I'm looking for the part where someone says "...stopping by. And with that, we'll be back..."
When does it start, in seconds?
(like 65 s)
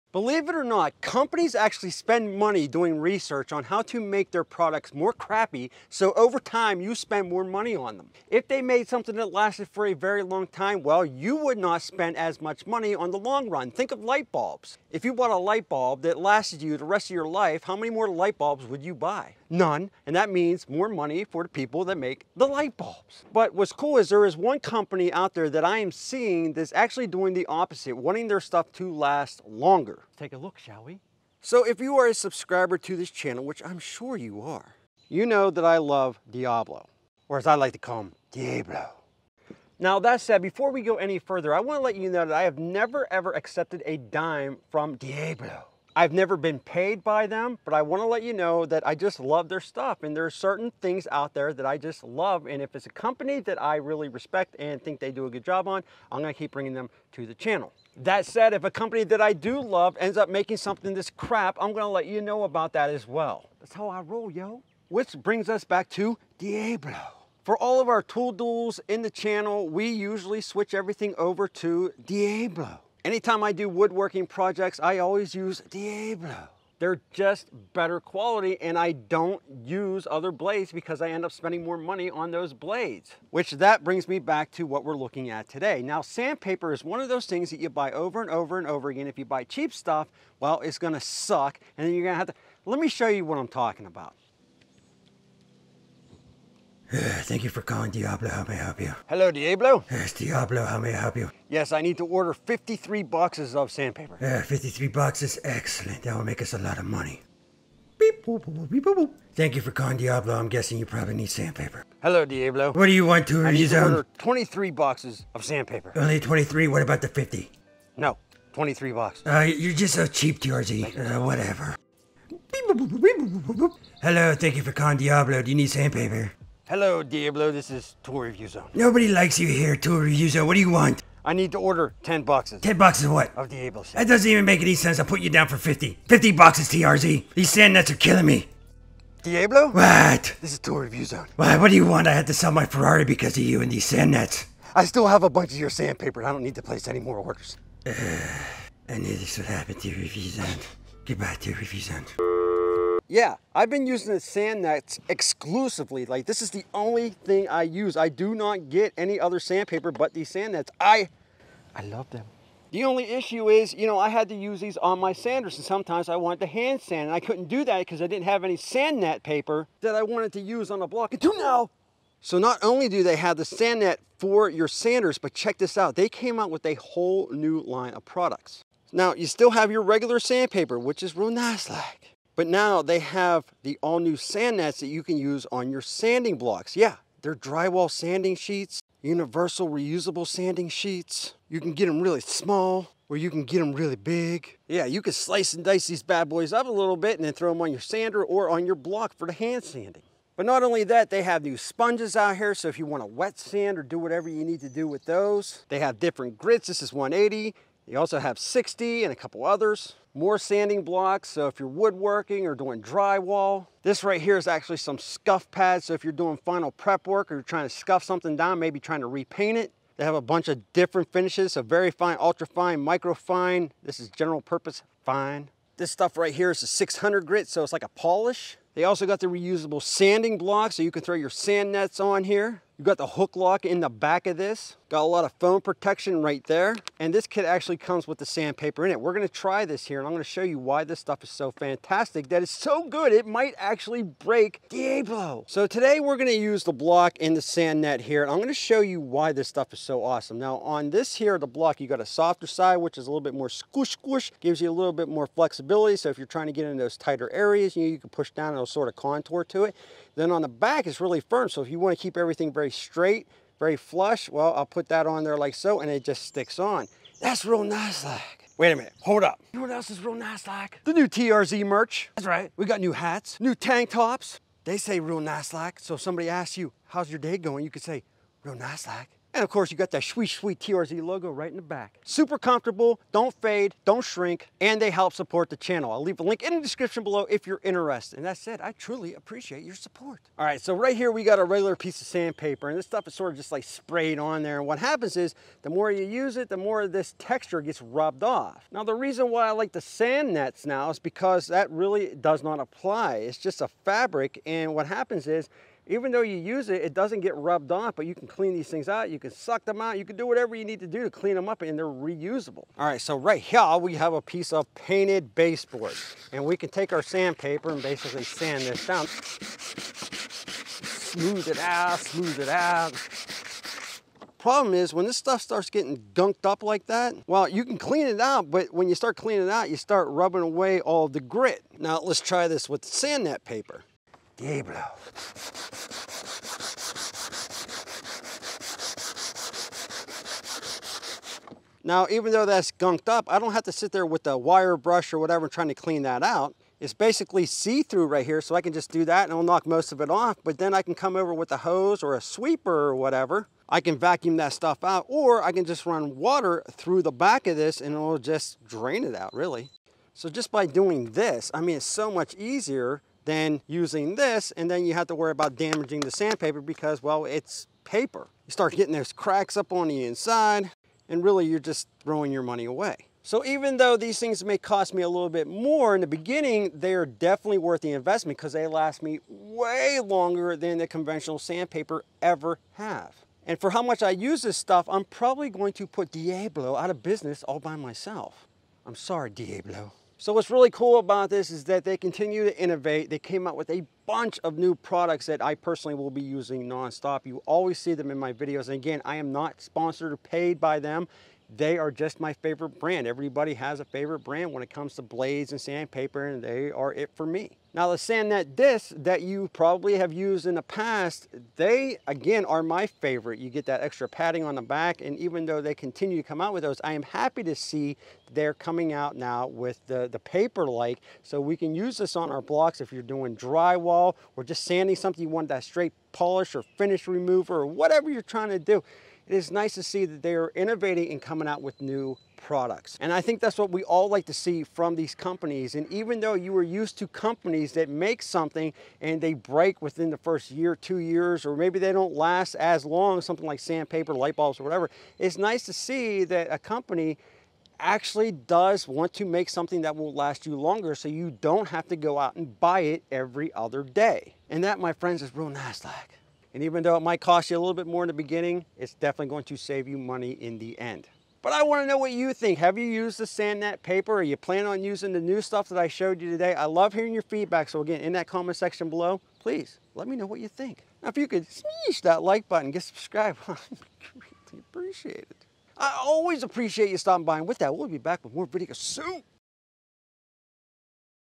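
476 s.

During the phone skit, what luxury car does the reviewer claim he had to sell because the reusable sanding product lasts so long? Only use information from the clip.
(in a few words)
Ferrari.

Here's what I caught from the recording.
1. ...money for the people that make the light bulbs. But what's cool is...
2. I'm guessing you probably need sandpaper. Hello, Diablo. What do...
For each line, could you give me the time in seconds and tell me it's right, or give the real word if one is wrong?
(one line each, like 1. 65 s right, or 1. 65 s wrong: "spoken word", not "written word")
1. 20 s right
2. 110 s right.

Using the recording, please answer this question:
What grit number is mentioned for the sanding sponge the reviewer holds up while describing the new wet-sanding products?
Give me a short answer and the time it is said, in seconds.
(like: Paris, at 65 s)
180, at 206 s.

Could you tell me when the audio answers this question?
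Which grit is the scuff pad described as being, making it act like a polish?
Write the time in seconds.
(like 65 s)
226 s.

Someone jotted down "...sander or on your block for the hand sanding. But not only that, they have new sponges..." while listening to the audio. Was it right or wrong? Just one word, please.
right.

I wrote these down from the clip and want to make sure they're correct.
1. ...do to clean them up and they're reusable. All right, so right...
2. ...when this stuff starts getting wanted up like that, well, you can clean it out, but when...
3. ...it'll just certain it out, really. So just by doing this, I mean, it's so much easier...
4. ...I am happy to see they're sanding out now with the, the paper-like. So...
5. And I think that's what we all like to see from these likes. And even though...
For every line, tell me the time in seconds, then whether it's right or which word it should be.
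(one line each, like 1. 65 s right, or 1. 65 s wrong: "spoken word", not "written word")
1. 310 s right
2. 324 s wrong: "gunked", not "wanted"
3. 357 s wrong: "drain", not "certain"
4. 416 s wrong: "coming", not "sanding"
5. 432 s wrong: "companies", not "likes".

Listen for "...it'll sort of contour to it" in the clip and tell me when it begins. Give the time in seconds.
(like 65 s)
258 s.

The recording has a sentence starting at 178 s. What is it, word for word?
Now, you still have your regular sandpaper, which is real nice like.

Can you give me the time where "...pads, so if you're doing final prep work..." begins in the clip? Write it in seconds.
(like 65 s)
215 s.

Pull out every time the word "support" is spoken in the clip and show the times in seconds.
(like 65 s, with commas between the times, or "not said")
285 s, 289 s.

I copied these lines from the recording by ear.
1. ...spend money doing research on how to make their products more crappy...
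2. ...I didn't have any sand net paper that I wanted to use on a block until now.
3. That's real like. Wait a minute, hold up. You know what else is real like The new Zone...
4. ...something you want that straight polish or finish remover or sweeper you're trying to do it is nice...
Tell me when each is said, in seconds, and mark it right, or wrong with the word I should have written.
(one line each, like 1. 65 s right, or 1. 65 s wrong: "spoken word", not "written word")
1. 1 s right
2. 168 s right
3. 267 s wrong: "TRZ", not "Zone"
4. 424 s wrong: "whatever", not "sweeper".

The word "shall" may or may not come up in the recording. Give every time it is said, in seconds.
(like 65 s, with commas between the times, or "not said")
30 s.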